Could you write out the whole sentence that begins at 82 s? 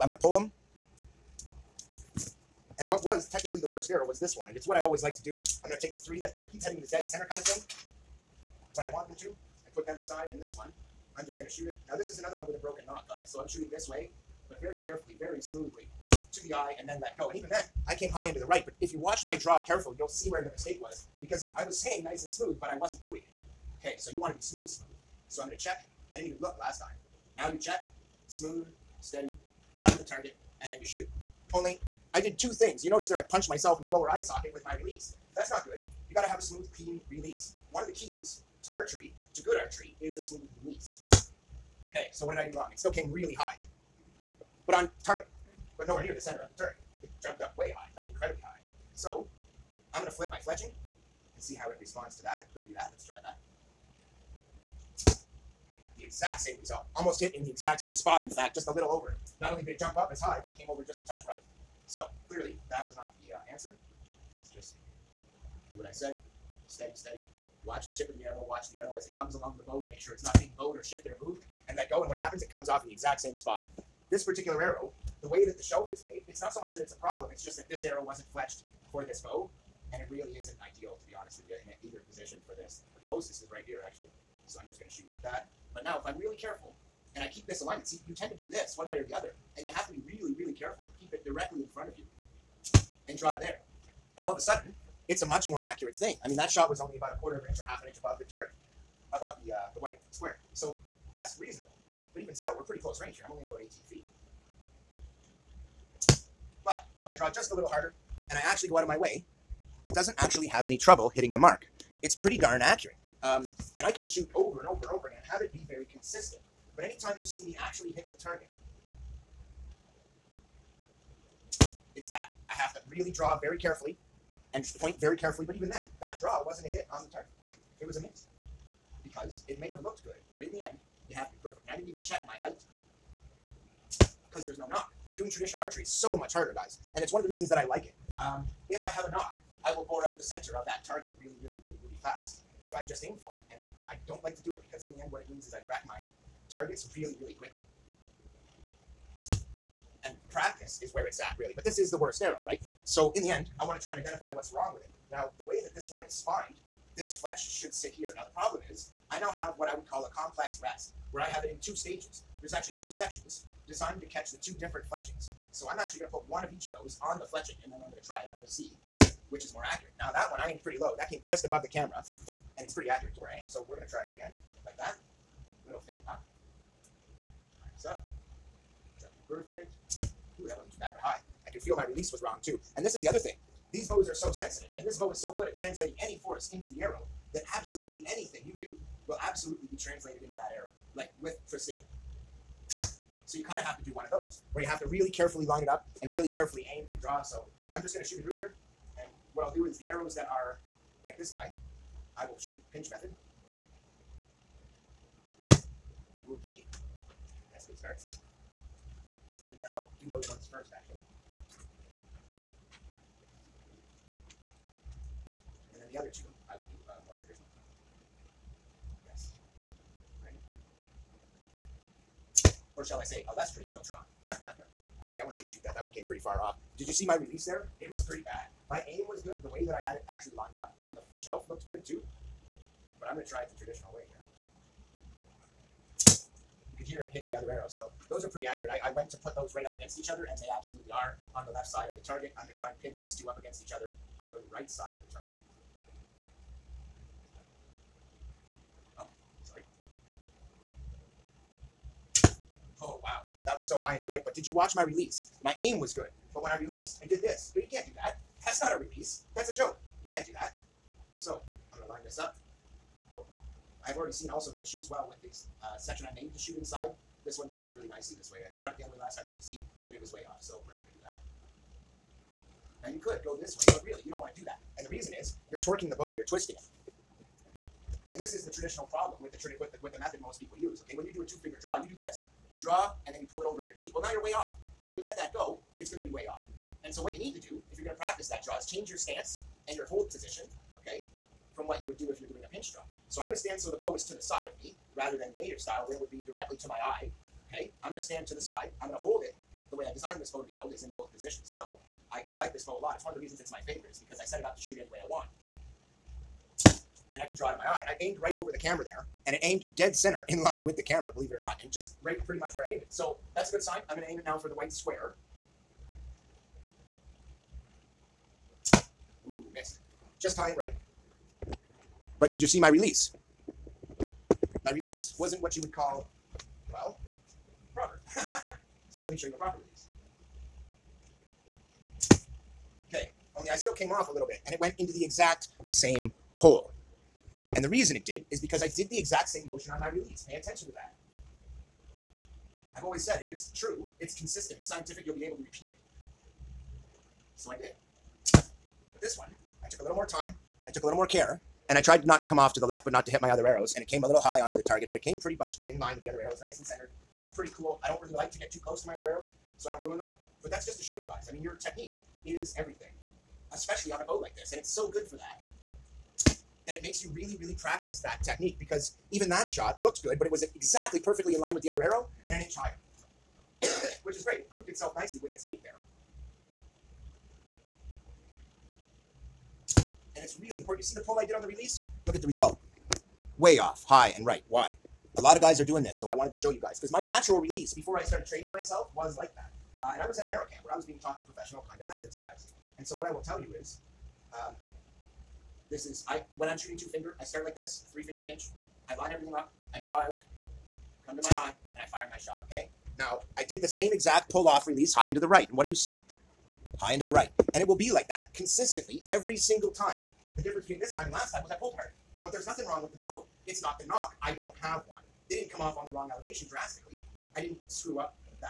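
The closest is right here, actually.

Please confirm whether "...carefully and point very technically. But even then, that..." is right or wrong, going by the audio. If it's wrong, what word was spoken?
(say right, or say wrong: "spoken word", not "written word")
wrong: "carefully", not "technically".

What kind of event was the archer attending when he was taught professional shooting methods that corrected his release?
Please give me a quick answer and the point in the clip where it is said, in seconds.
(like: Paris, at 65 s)
Arrow camp, at 390 s.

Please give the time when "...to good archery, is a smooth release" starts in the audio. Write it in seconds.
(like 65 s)
39 s.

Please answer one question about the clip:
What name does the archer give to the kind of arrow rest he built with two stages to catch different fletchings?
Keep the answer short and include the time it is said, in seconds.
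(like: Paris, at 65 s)
Complex rest, at 160 s.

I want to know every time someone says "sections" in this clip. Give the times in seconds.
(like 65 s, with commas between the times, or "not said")
162 s, 265 s.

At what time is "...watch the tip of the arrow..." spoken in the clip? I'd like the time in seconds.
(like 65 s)
67 s.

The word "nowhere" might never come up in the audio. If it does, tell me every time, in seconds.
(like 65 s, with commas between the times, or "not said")
45 s.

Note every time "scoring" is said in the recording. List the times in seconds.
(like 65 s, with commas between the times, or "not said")
not said.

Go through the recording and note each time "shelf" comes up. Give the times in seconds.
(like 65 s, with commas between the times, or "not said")
75 s, 231 s.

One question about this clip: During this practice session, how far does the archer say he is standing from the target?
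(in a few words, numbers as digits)
About 18.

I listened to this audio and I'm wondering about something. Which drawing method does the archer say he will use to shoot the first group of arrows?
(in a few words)
Pinch method.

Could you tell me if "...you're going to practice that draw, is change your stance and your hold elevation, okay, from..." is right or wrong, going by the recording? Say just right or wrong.
wrong.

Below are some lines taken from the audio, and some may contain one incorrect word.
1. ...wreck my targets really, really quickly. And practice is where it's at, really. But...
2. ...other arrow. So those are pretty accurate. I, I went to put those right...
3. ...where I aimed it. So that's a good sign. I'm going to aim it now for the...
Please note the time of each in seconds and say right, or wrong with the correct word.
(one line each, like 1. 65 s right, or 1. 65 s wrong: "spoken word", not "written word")
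1. 145 s right
2. 237 s right
3. 312 s right.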